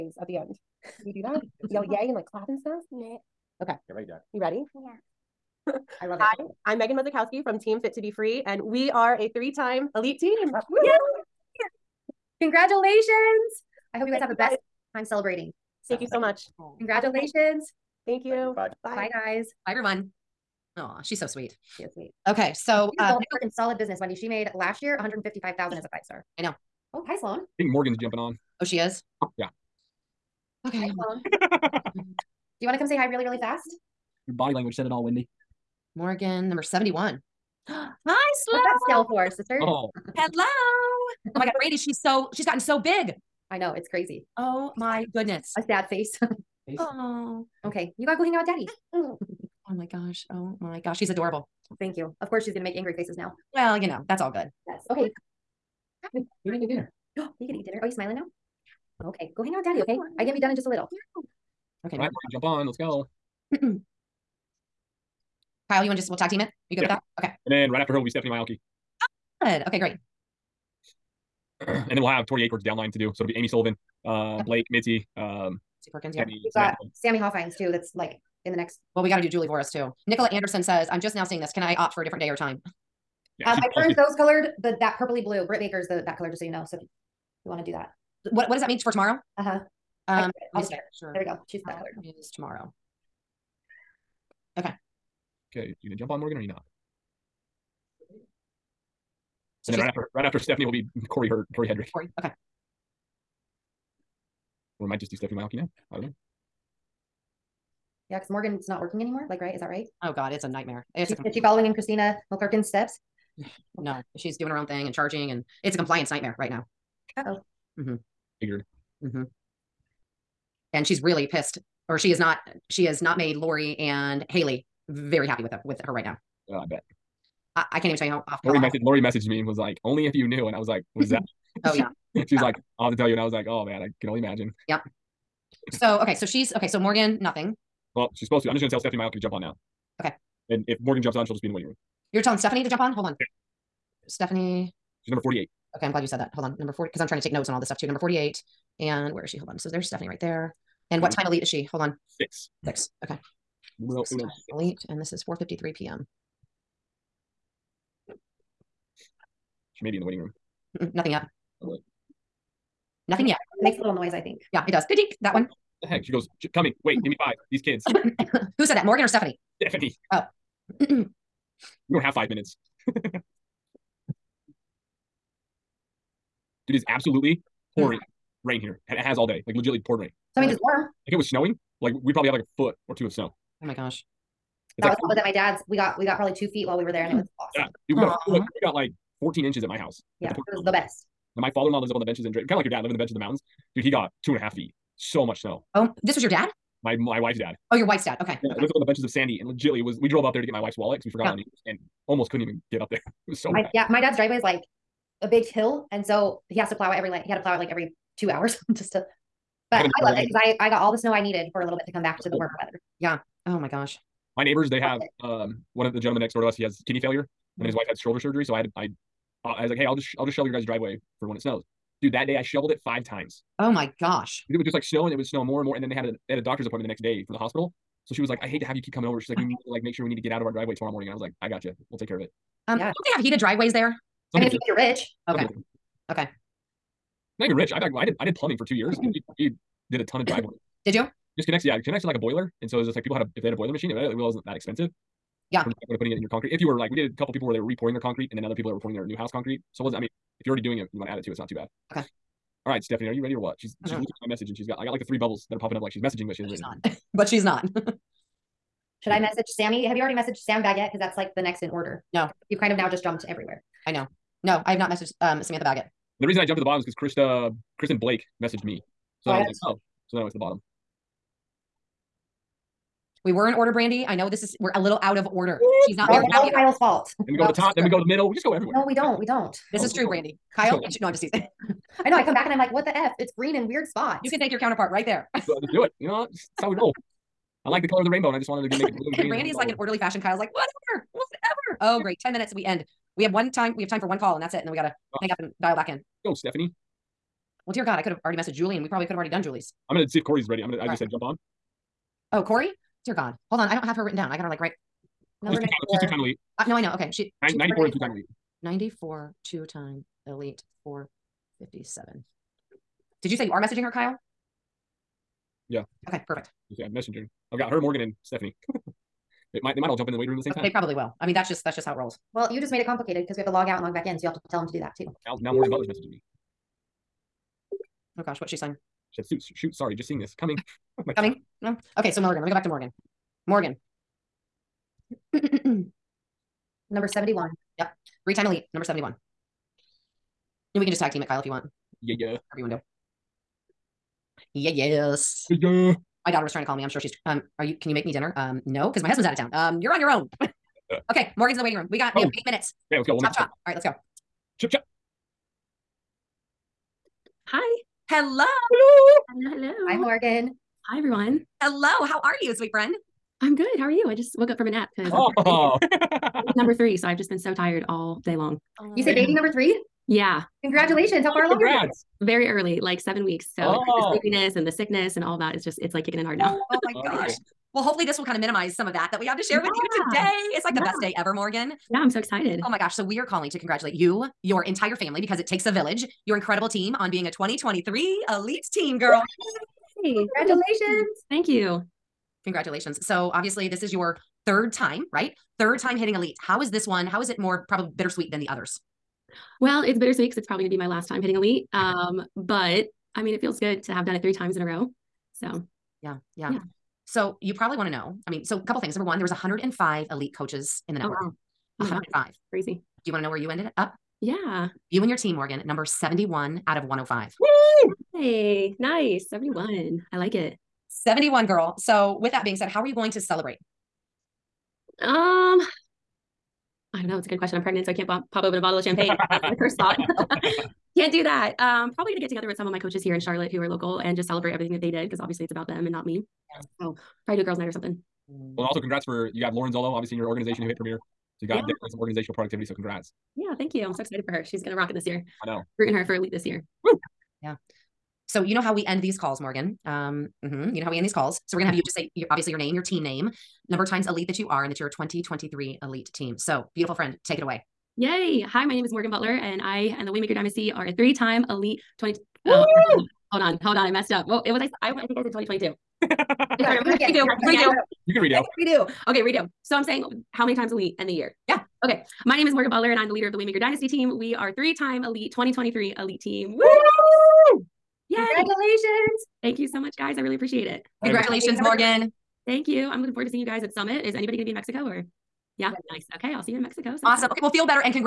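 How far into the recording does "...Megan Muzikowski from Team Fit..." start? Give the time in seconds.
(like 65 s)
6 s.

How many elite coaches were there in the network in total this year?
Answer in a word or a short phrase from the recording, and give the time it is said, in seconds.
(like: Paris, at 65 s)
105, at 409 s.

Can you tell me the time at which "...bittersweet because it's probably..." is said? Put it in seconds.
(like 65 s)
399 s.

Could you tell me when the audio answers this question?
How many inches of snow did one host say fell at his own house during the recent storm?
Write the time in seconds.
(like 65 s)
189 s.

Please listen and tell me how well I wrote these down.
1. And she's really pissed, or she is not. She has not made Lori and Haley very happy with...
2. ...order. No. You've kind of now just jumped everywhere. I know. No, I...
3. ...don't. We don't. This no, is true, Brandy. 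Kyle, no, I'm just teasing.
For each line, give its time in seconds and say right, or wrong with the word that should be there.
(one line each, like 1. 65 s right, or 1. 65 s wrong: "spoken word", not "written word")
1. 120 s right
2. 261 s right
3. 278 s right.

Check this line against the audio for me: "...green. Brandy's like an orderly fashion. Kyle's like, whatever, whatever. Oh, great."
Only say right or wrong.
right.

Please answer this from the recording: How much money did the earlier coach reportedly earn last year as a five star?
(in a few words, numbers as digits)
$155,000.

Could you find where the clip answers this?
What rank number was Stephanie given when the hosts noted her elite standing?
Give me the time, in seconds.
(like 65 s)
145 s.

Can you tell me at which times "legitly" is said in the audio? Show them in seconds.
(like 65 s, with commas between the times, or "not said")
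179 s, 199 s.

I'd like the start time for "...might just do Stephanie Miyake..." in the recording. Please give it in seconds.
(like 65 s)
104 s.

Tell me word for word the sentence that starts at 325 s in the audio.
Now, now Morgan Butler's messaging me.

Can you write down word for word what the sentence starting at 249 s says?
So it wasn't, I mean, if you're already doing it, you want to add it to it's not too bad.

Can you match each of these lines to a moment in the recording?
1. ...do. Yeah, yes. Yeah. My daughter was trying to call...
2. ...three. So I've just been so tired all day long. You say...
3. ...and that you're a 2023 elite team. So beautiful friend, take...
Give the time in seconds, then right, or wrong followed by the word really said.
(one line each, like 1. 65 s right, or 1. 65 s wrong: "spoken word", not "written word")
1. 342 s right
2. 366 s right
3. 454 s right.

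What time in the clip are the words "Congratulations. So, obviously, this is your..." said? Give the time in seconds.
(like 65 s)
392 s.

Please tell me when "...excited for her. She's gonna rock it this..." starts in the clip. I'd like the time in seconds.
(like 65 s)
444 s.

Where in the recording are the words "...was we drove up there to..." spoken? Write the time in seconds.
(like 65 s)
199 s.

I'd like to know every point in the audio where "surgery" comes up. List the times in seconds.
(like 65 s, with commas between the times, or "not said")
218 s.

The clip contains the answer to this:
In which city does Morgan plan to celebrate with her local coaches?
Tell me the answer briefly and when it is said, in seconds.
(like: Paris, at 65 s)
Charlotte, at 433 s.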